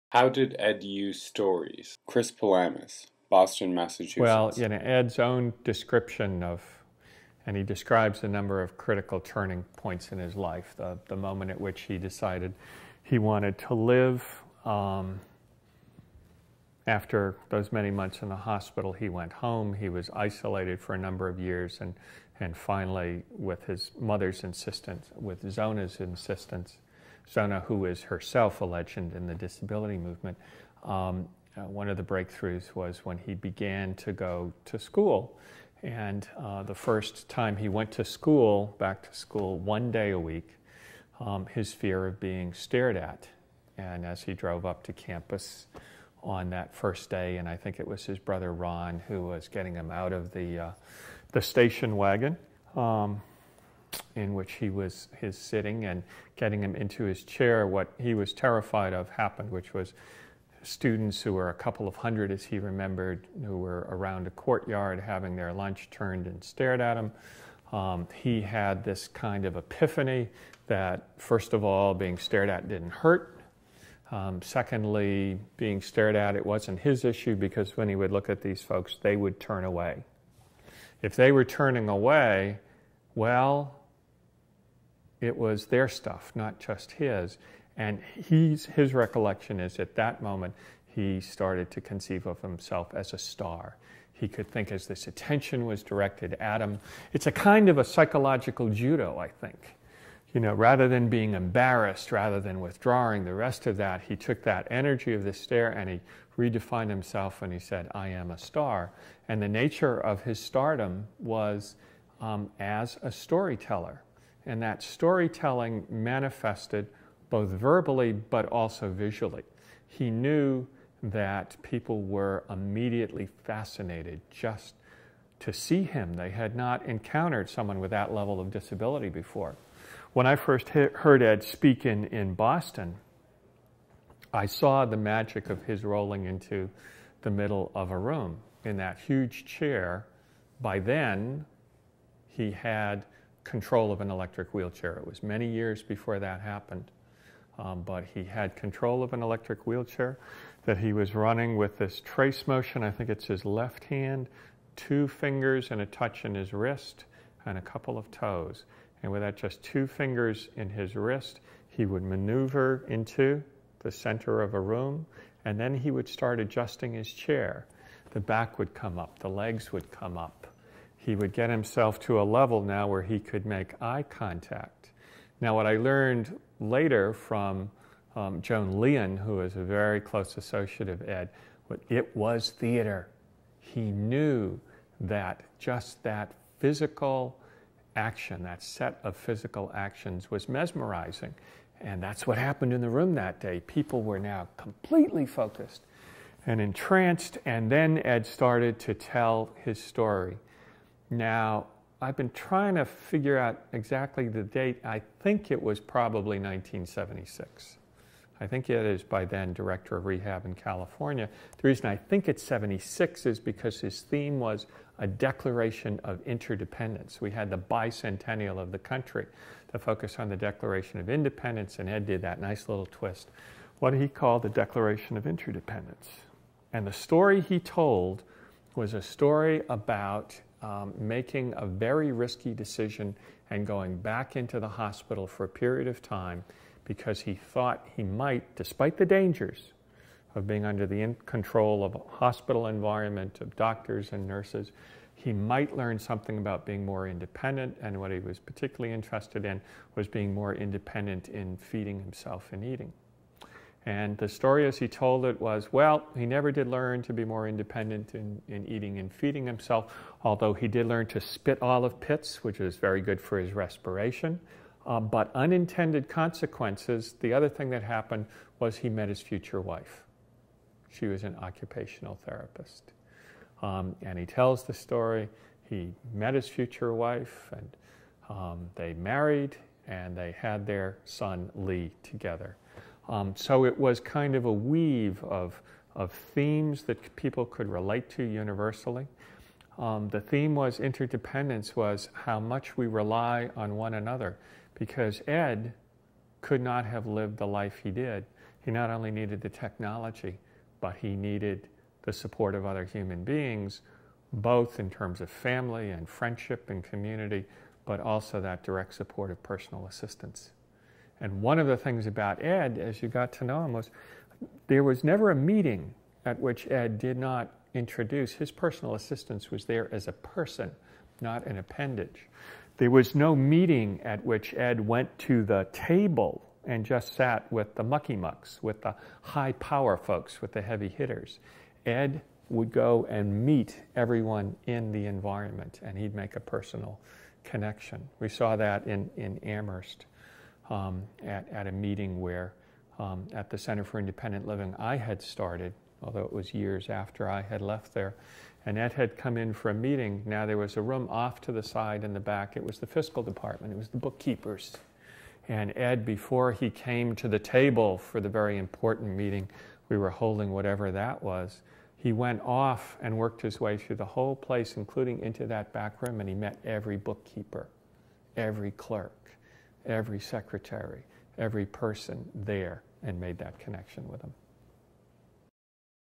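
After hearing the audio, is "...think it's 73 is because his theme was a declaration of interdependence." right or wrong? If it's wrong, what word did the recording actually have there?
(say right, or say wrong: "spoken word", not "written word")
wrong: "76", not "73".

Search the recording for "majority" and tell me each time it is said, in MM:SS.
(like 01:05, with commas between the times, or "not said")
not said.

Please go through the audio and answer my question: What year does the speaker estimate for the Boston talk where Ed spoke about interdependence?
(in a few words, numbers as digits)
1976.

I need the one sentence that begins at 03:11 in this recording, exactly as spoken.
And that's what happened in the room that day.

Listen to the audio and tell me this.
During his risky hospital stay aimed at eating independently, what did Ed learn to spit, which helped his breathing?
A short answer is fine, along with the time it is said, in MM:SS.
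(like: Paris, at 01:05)
olive pits, at 04:21.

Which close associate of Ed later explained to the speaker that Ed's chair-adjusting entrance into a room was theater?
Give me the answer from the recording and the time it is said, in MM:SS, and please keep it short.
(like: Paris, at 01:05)
Joan Leon, at 02:58.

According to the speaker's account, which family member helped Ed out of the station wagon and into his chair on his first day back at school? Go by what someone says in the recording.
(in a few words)
Ron.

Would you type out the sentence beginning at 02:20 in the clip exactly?
By then, he had control of an electric wheelchair.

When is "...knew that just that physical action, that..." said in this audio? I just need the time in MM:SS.
03:03.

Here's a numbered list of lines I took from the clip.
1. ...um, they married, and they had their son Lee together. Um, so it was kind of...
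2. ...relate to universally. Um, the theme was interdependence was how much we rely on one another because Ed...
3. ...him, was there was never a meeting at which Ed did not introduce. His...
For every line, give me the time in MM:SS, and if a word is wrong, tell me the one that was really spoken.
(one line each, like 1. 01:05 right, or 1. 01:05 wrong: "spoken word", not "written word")
1. 04:38 right
2. 04:47 right
3. 05:13 right.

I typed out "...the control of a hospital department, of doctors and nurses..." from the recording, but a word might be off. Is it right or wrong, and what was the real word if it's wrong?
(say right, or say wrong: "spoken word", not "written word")
wrong: "environment", not "department".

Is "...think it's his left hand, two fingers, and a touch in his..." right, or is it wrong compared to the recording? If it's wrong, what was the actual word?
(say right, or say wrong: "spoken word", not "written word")
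right.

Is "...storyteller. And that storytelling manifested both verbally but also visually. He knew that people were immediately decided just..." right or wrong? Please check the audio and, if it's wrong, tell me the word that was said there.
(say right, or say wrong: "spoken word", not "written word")
wrong: "fascinated", not "decided".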